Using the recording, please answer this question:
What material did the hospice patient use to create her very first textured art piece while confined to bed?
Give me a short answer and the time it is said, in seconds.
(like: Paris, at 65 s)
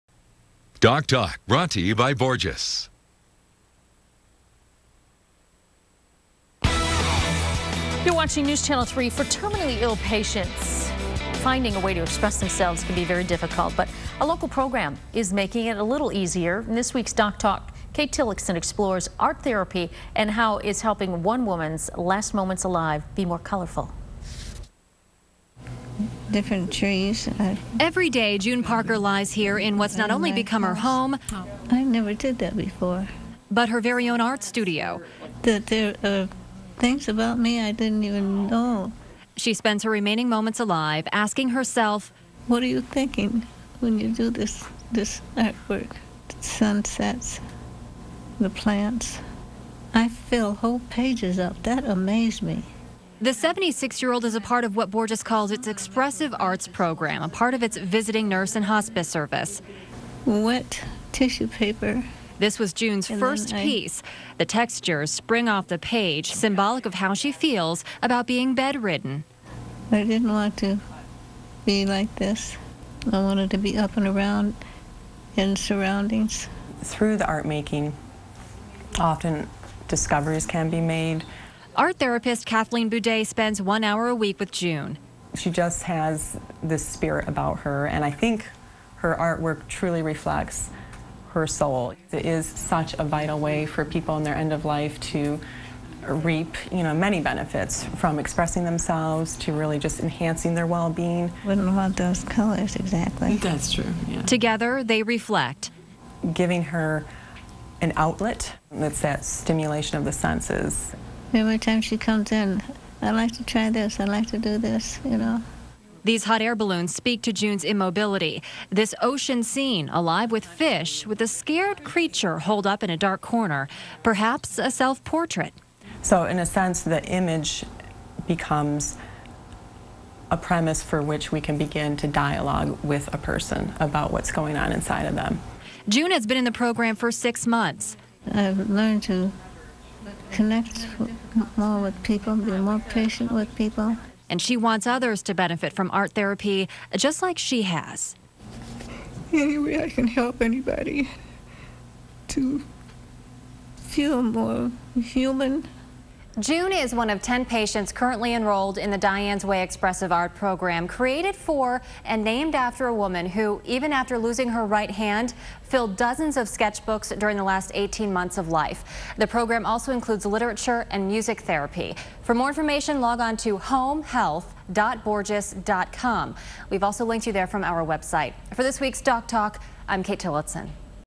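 Wet tissue paper, at 60 s.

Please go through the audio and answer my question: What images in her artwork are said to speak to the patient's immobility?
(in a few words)
Hot air balloons.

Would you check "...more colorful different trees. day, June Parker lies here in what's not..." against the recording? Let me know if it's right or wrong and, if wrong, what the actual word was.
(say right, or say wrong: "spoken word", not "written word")
right.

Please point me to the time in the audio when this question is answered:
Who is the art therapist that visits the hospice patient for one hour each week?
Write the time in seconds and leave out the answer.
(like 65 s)
82 s.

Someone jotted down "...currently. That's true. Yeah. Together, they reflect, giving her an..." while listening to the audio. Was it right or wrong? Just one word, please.
wrong.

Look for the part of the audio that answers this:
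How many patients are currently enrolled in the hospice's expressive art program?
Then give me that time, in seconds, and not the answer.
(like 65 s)
157 s.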